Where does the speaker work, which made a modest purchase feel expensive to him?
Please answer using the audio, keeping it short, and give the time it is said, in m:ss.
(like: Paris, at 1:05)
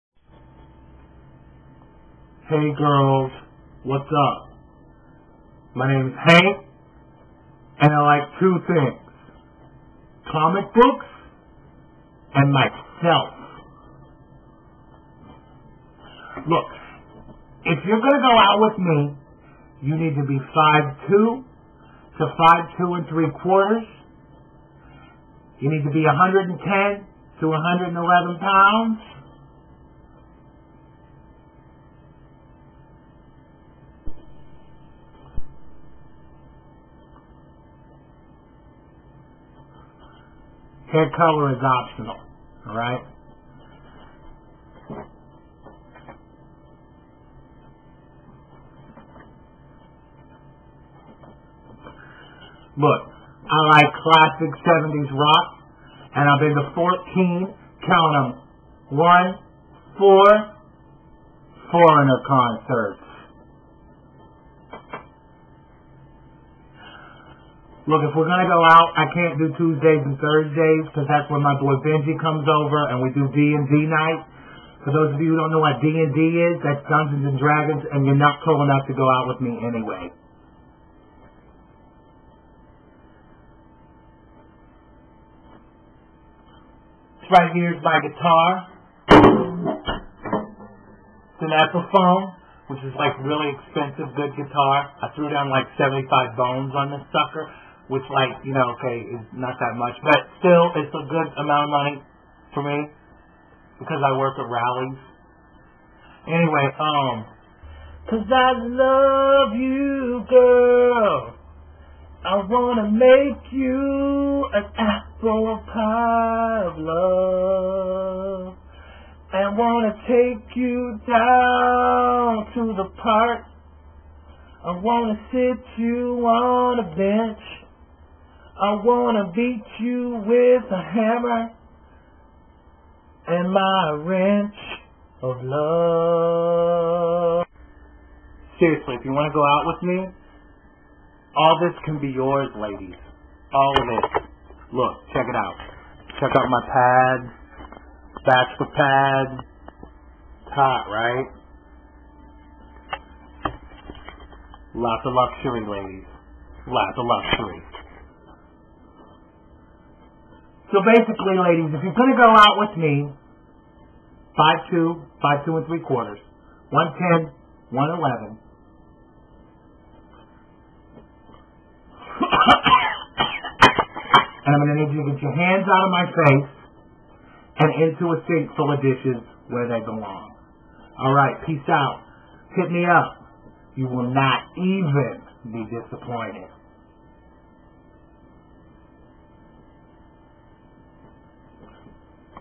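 Rally's, at 1:44.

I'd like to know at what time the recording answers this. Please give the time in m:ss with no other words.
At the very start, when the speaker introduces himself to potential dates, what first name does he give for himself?
0:06.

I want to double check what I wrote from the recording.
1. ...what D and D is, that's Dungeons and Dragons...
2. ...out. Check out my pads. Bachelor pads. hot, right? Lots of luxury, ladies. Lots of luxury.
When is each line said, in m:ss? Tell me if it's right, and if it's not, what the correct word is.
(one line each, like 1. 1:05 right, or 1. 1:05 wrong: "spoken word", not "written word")
1. 1:15 right
2. 2:25 right.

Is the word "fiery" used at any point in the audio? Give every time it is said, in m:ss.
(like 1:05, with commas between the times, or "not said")
not said.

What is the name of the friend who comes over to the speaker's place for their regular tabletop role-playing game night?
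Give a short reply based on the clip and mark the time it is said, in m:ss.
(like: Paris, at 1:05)
Benji, at 1:11.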